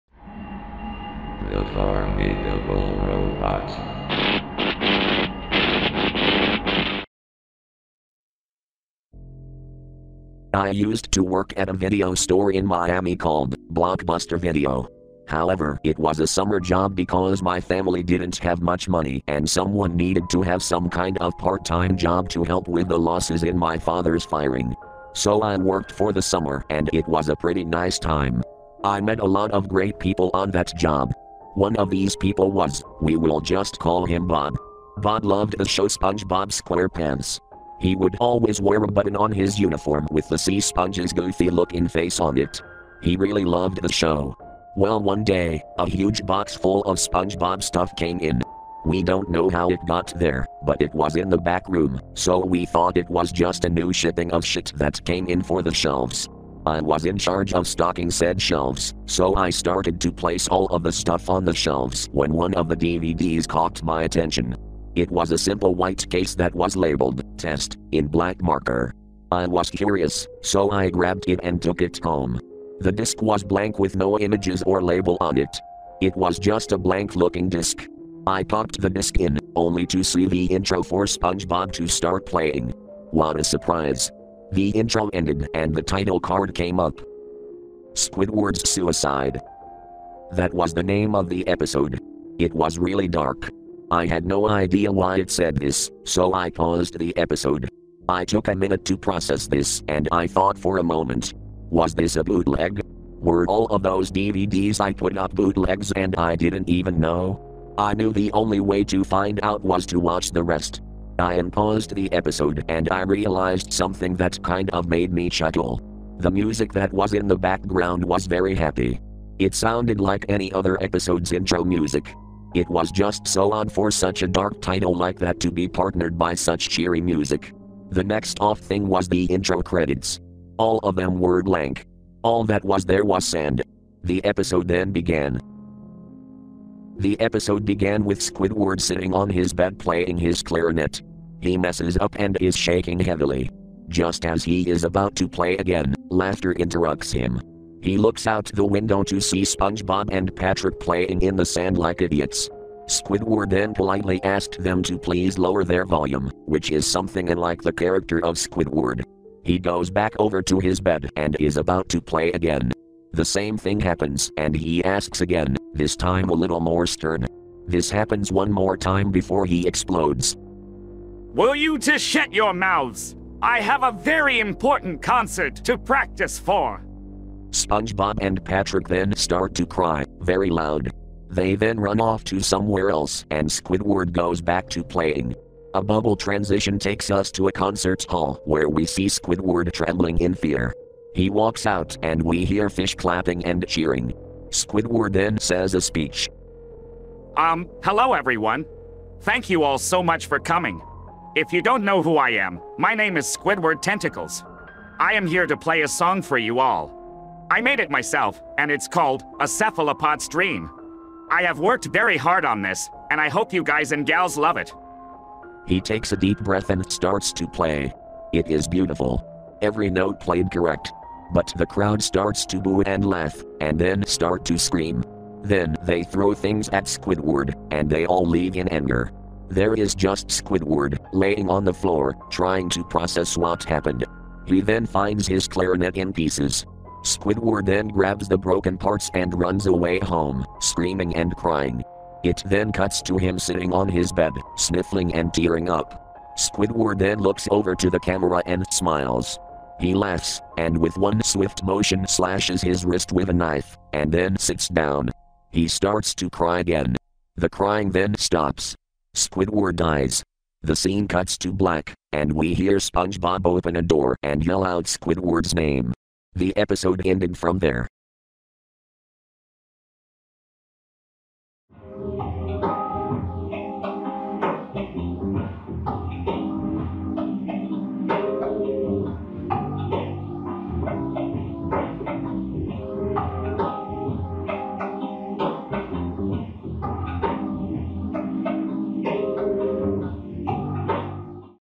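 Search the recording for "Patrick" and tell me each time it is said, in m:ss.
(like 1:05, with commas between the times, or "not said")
2:30, 2:58.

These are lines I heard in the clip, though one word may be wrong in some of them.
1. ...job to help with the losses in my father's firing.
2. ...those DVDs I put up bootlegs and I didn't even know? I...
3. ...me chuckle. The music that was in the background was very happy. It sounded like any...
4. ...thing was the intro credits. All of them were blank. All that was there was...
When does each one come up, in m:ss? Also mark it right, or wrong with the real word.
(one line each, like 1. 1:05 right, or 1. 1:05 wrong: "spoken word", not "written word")
1. 0:21 right
2. 1:43 right
3. 1:55 right
4. 2:08 right.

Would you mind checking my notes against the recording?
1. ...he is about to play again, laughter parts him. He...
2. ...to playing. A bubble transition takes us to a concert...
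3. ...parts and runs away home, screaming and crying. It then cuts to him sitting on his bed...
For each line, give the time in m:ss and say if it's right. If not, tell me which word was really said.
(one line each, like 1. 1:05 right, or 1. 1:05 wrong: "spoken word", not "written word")
1. 2:24 wrong: "interrupts", not "parts"
2. 3:04 right
3. 3:58 right.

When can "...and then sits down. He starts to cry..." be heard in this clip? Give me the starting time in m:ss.
4:13.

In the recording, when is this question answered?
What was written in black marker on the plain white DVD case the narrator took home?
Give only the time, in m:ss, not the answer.
1:07.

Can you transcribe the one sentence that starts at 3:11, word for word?
He walks out, and we hear fish clapping and cheering.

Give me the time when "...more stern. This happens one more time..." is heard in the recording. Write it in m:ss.
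2:46.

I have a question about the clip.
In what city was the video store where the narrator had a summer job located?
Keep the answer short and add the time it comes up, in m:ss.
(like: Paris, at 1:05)
Miami, at 0:12.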